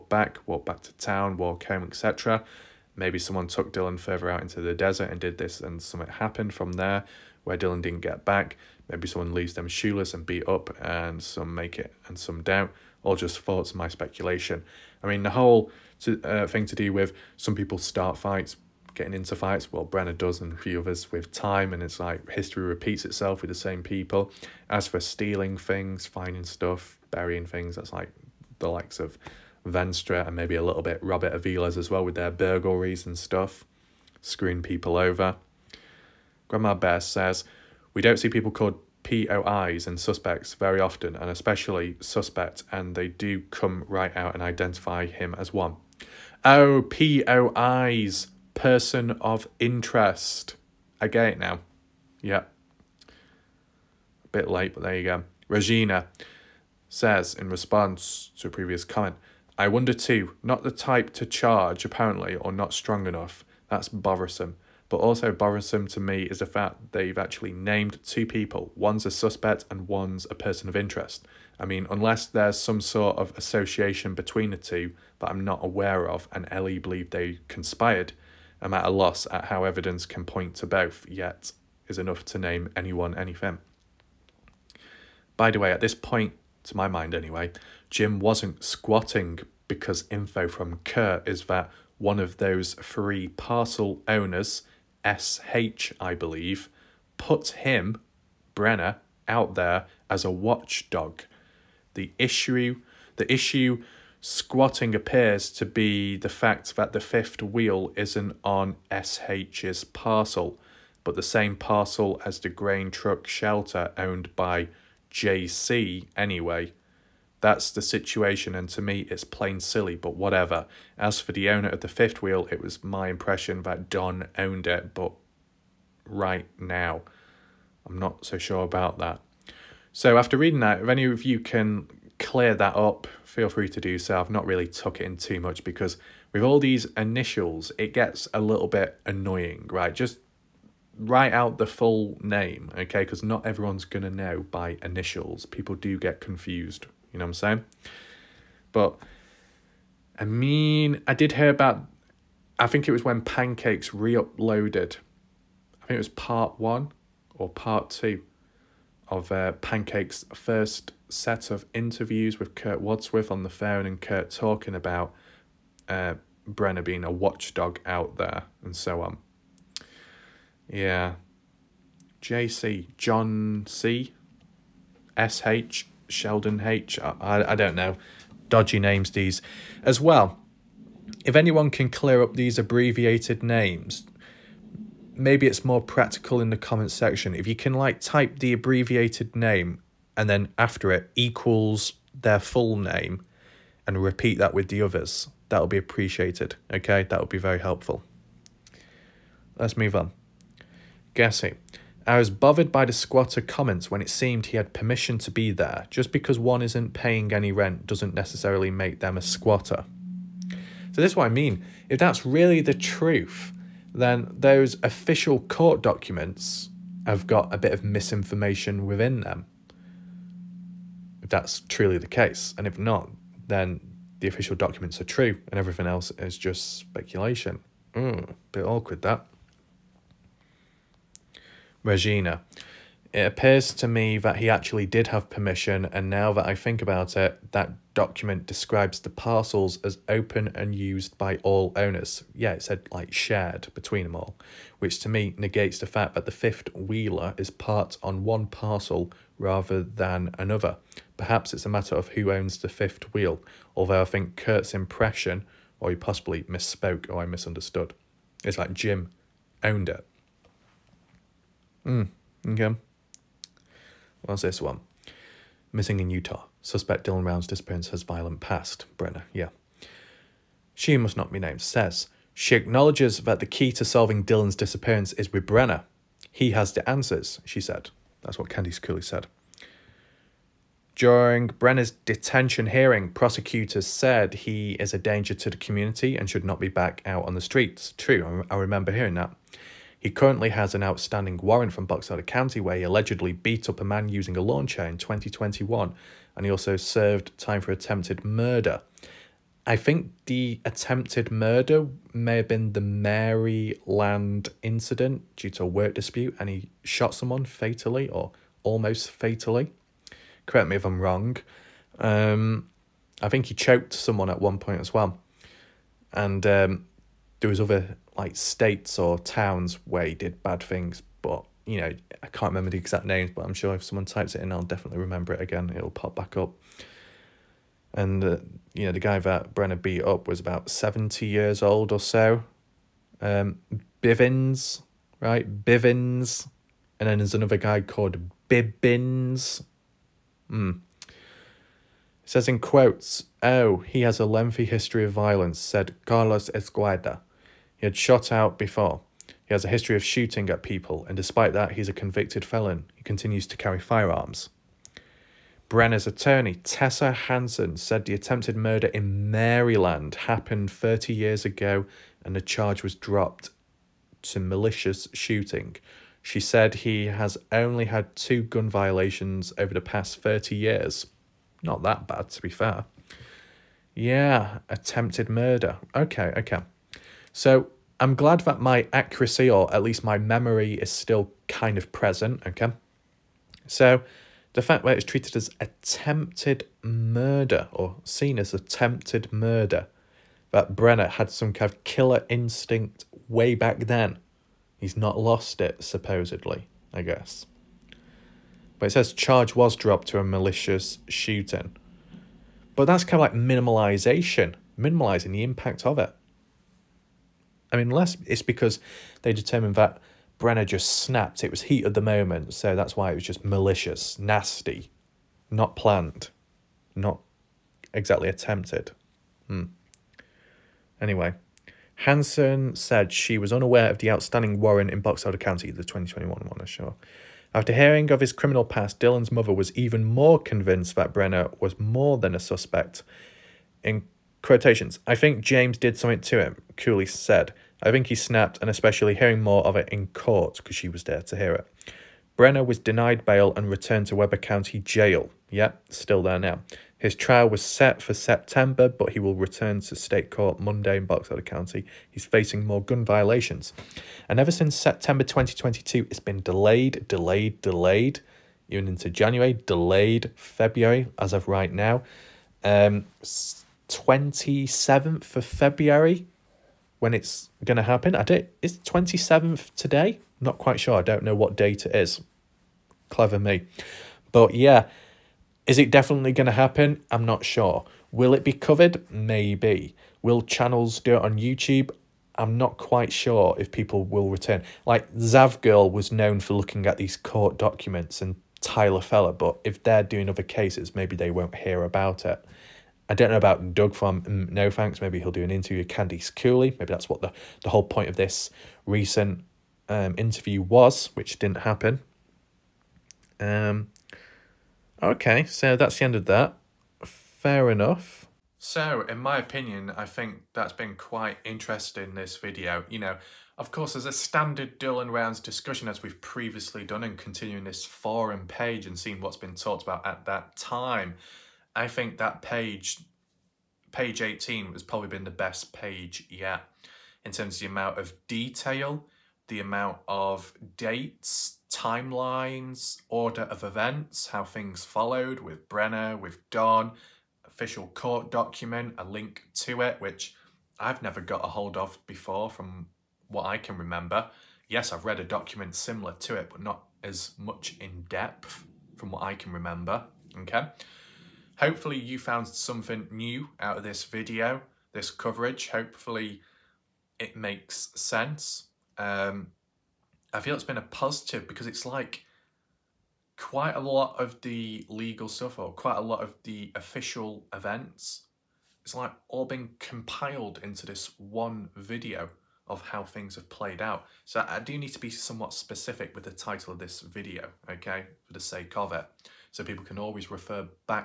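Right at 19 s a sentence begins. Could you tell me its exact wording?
Well, Brenner does and a few others with time, and it's like history repeats itself with the same people.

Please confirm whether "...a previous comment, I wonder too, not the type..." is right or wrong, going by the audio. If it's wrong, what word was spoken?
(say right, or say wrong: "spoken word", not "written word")
right.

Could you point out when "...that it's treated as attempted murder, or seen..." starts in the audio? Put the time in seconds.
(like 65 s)
384 s.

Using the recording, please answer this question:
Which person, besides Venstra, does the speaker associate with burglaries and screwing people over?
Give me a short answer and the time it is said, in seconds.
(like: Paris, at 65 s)
Robert Aviles, at 31 s.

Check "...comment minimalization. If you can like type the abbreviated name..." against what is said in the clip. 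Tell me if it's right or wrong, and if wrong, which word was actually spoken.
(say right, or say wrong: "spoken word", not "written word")
wrong: "section", not "minimalization".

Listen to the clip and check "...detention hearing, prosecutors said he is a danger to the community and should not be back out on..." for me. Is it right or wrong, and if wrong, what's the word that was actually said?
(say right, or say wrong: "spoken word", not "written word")
right.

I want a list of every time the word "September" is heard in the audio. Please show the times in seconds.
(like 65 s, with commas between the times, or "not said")
448 s, 454 s.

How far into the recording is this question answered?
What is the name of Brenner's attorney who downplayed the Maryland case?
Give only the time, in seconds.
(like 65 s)
356 s.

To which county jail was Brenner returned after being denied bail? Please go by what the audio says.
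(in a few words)
Weber County.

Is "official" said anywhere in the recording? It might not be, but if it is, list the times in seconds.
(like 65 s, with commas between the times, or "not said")
214 s, 224 s, 537 s, 566 s.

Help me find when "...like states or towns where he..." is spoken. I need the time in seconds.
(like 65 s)
318 s.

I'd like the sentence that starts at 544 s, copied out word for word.
Yes, I've read a document similar to it, but not as much in depth from what I can remember, okay?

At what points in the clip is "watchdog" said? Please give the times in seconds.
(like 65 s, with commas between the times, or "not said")
100 s, 167 s.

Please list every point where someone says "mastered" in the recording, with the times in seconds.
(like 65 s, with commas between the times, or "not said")
not said.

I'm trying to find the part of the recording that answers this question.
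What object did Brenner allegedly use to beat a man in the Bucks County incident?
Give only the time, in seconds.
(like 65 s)
294 s.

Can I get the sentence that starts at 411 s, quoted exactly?
It was heat of the moment, so that's why it was just malicious, nasty, not planned, not exactly attempted.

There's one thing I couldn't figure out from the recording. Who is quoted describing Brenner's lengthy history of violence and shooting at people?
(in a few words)
Carlos Esqueda.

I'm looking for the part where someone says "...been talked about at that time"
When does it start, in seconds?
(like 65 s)
519 s.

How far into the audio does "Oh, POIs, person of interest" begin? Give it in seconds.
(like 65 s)
46 s.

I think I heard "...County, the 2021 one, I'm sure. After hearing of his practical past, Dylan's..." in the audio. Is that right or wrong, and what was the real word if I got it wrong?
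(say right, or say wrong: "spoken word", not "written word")
wrong: "criminal", not "practical".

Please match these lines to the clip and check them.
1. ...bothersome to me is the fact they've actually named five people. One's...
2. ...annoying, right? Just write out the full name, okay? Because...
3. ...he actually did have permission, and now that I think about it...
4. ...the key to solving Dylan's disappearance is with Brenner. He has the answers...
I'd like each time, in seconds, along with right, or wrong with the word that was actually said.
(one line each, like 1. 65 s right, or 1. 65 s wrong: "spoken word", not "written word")
1. 65 s wrong: "two", not "five"
2. 139 s right
3. 234 s right
4. 273 s right.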